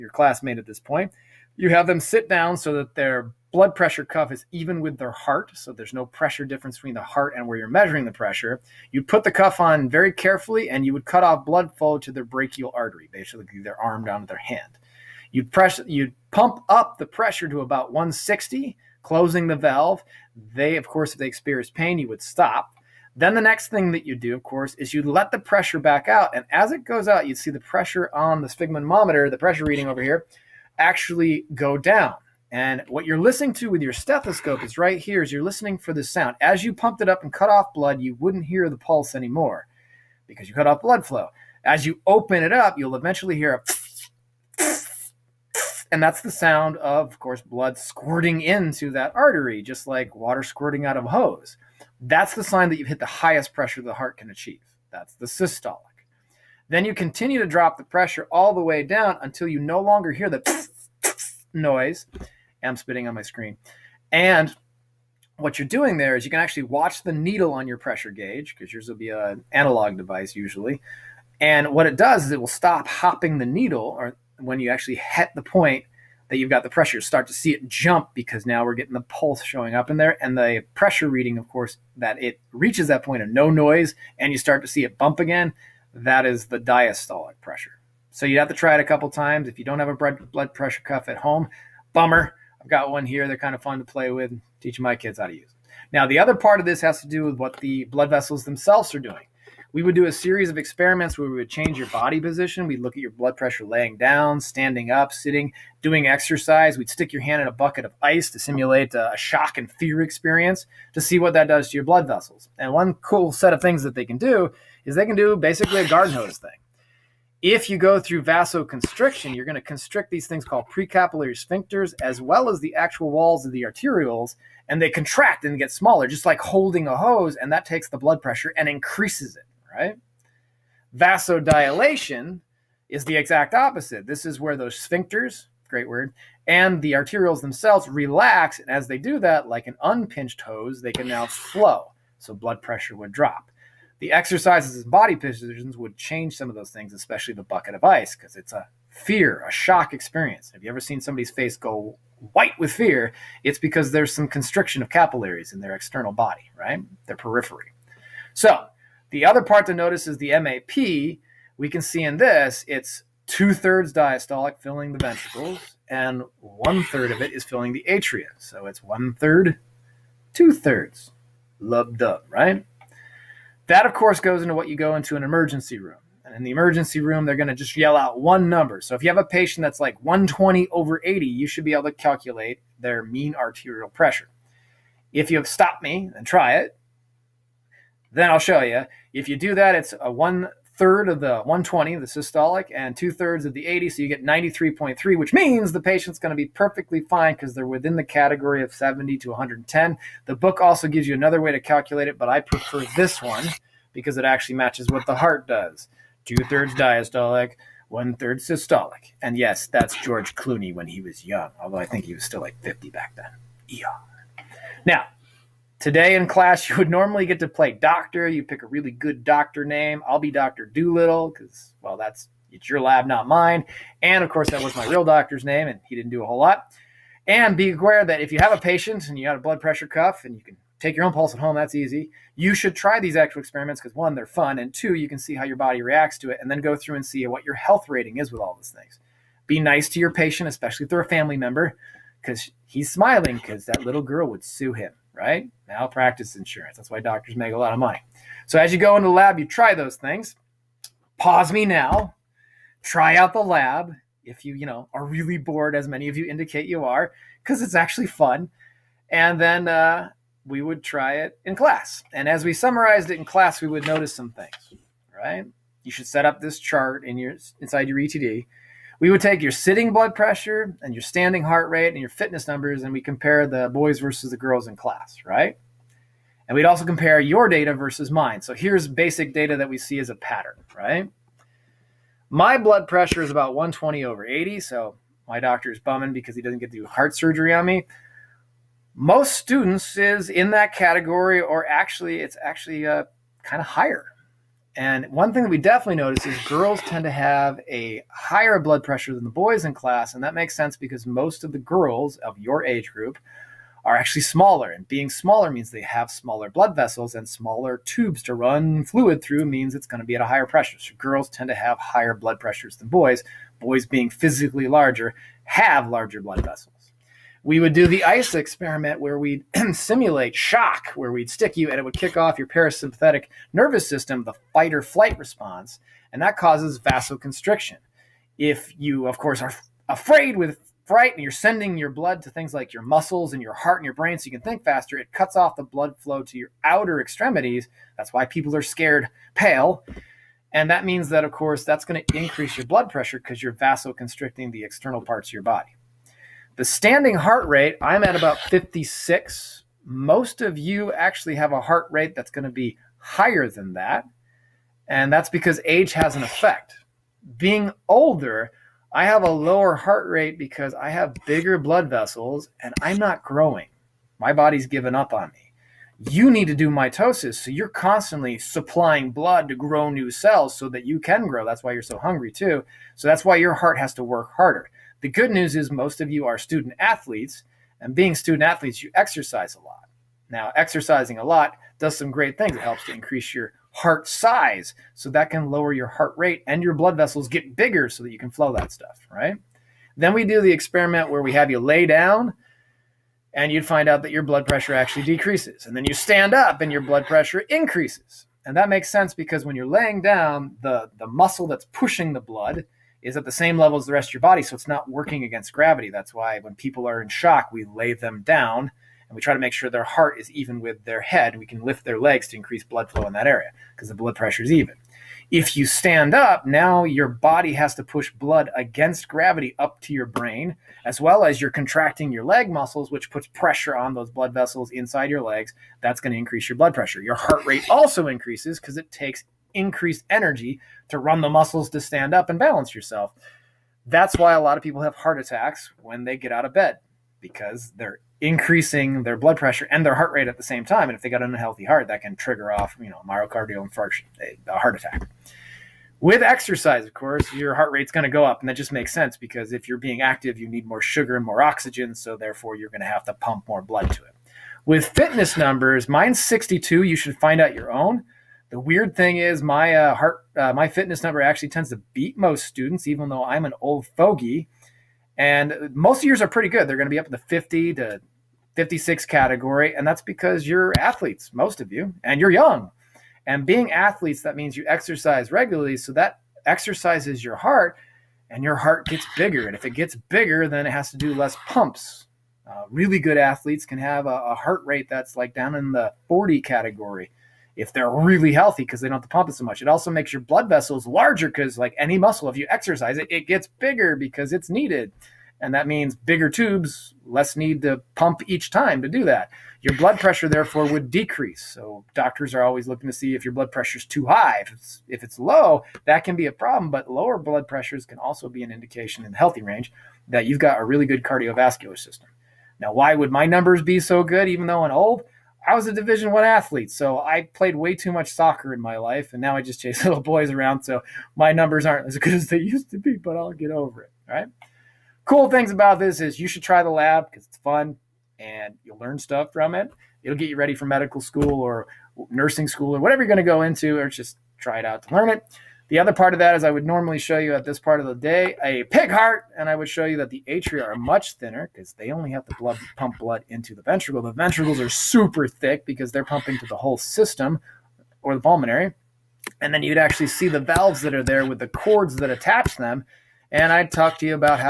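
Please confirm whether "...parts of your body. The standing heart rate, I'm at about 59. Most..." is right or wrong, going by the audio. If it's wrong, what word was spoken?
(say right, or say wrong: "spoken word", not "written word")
wrong: "56", not "59".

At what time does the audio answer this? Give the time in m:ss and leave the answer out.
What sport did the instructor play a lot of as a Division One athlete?
8:38.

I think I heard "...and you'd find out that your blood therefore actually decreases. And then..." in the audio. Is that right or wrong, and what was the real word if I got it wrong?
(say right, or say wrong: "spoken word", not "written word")
wrong: "pressure", not "therefore".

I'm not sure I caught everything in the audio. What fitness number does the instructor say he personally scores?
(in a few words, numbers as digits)
62.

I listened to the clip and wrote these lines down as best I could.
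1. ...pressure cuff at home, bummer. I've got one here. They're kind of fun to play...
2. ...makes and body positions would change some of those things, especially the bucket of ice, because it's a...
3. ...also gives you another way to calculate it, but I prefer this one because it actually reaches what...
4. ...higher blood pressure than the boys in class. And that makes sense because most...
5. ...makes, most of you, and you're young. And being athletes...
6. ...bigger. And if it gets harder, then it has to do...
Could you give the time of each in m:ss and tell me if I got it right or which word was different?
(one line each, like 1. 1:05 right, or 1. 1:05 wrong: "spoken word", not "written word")
1. 1:30 right
2. 2:24 wrong: "exercises", not "makes"
3. 3:20 wrong: "matches", not "reaches"
4. 4:58 right
5. 7:50 wrong: "athletes", not "makes"
6. 7:59 wrong: "bigger", not "harder".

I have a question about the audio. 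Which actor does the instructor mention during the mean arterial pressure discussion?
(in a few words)
George Clooney.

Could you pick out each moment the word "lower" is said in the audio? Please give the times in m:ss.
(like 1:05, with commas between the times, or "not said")
5:59, 6:25, 8:26.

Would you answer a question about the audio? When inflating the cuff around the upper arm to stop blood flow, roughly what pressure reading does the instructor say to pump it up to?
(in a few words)
160.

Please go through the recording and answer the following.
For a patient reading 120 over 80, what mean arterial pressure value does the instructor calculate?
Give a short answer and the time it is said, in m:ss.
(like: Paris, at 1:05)
93.3, at 3:14.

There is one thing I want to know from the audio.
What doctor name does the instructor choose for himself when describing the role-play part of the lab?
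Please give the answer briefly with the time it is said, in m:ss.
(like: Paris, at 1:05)
Dr. Doolittle, at 3:40.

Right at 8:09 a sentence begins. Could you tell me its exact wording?
It also makes your blood vessels larger because, like any muscle, if you exercise it, it gets bigger because it's needed.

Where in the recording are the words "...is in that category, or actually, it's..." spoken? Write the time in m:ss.
4:49.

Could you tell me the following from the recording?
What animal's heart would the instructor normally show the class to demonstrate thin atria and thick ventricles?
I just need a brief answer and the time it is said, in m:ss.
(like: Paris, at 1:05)
pig, at 8:58.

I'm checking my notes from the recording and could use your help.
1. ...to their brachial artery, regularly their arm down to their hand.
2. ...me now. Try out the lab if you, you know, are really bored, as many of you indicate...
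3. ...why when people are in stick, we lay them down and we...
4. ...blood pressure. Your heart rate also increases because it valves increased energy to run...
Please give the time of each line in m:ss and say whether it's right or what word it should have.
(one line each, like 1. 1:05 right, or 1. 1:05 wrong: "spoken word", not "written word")
1. 0:11 wrong: "basically", not "regularly"
2. 4:11 right
3. 6:46 wrong: "shock", not "stick"
4. 7:06 wrong: "takes", not "valves".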